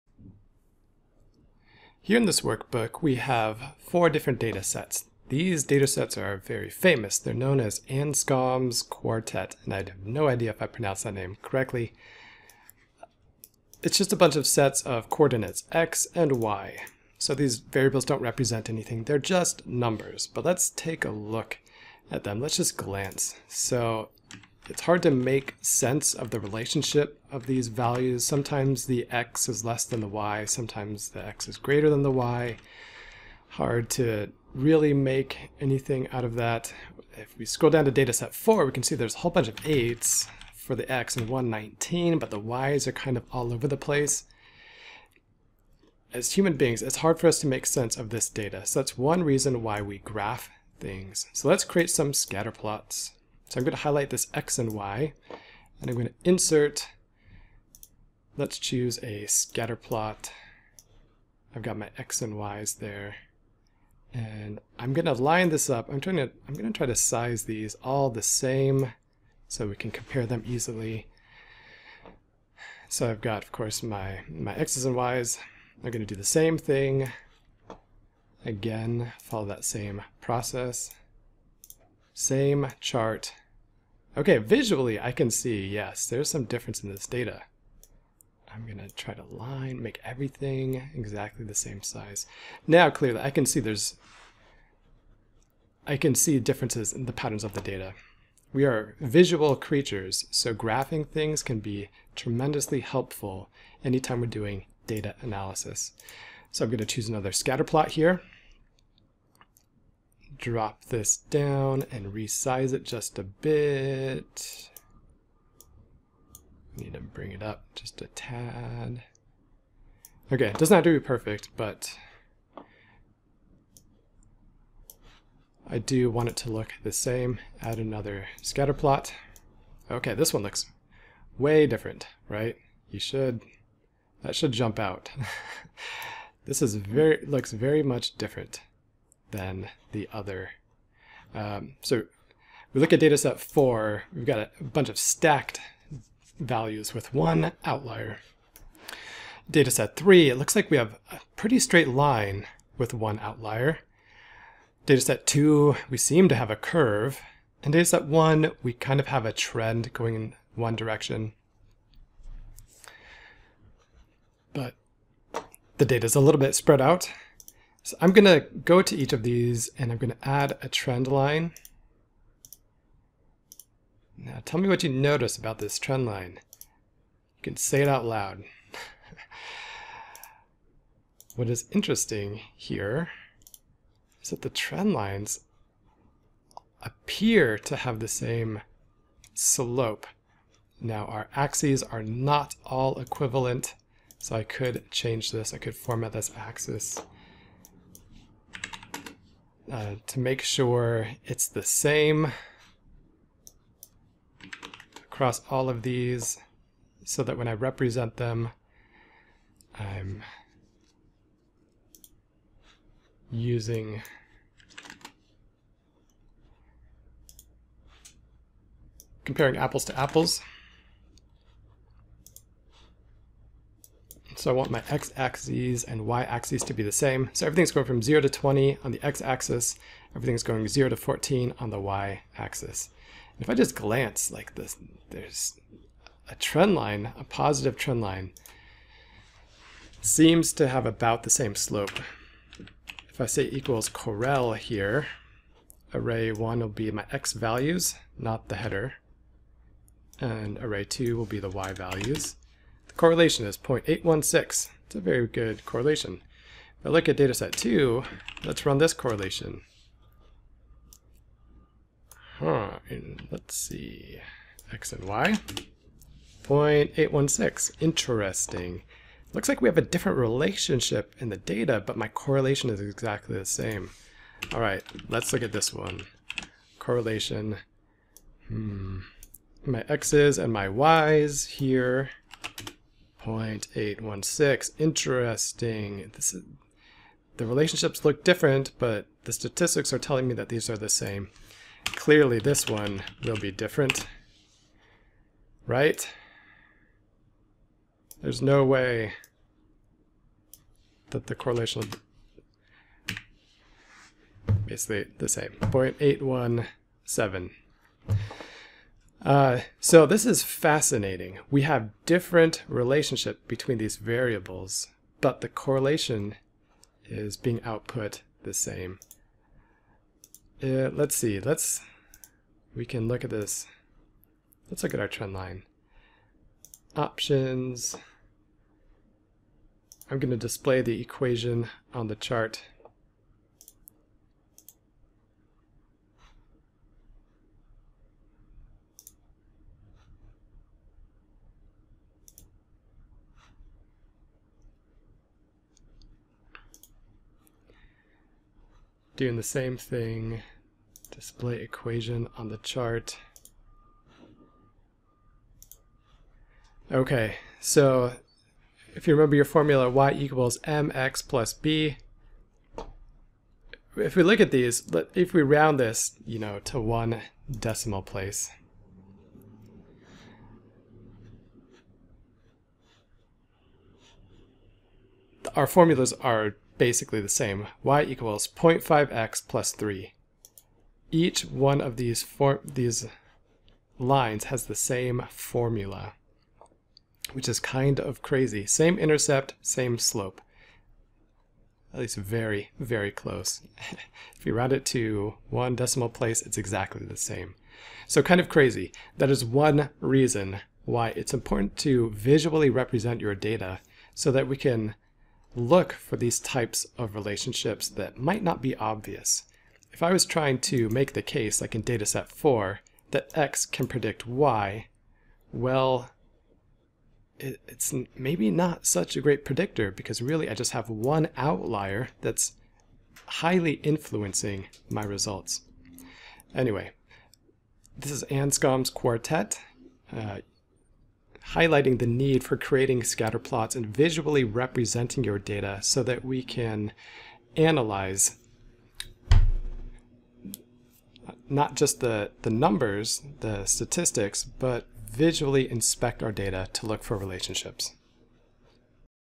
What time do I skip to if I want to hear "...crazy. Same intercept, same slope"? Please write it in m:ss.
6:28.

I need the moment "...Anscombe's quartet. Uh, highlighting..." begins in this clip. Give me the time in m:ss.
7:08.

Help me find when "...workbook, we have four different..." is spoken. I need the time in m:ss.
0:02.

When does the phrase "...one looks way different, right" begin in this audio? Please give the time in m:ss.
2:10.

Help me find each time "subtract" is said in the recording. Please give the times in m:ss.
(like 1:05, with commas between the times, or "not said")
not said.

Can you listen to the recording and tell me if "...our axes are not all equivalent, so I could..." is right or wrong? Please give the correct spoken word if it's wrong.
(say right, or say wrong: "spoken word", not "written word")
right.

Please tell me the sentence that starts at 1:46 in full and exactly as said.
So I'm gonna choose another scatter plot here drop this down and resize it just a bit.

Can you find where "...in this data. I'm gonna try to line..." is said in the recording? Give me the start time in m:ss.
1:26.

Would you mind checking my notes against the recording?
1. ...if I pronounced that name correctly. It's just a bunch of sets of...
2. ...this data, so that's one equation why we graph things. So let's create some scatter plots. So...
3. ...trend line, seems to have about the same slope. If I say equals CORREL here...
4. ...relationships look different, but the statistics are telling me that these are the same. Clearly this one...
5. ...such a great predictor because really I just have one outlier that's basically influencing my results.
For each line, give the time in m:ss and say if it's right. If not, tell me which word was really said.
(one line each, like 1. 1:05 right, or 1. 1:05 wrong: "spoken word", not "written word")
1. 0:10 right
2. 0:48 wrong: "reason", not "equation"
3. 3:57 right
4. 4:47 right
5. 6:58 wrong: "highly", not "basically".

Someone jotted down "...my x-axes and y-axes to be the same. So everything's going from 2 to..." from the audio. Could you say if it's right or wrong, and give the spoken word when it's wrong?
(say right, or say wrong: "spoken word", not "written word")
wrong: "0", not "2".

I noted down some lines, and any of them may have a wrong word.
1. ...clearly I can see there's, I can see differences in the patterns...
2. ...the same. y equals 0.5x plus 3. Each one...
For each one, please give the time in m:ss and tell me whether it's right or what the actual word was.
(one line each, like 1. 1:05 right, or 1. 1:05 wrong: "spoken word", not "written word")
1. 1:32 right
2. 6:17 right.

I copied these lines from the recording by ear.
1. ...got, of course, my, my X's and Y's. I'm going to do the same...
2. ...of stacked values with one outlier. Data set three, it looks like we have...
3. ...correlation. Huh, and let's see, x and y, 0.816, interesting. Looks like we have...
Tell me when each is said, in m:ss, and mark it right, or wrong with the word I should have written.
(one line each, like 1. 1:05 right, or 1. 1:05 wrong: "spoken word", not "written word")
1. 1:13 right
2. 2:24 right
3. 4:18 right.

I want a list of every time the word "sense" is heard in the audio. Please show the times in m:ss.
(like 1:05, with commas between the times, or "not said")
0:25, 0:47.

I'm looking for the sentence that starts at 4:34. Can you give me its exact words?
All right, let's look at this one.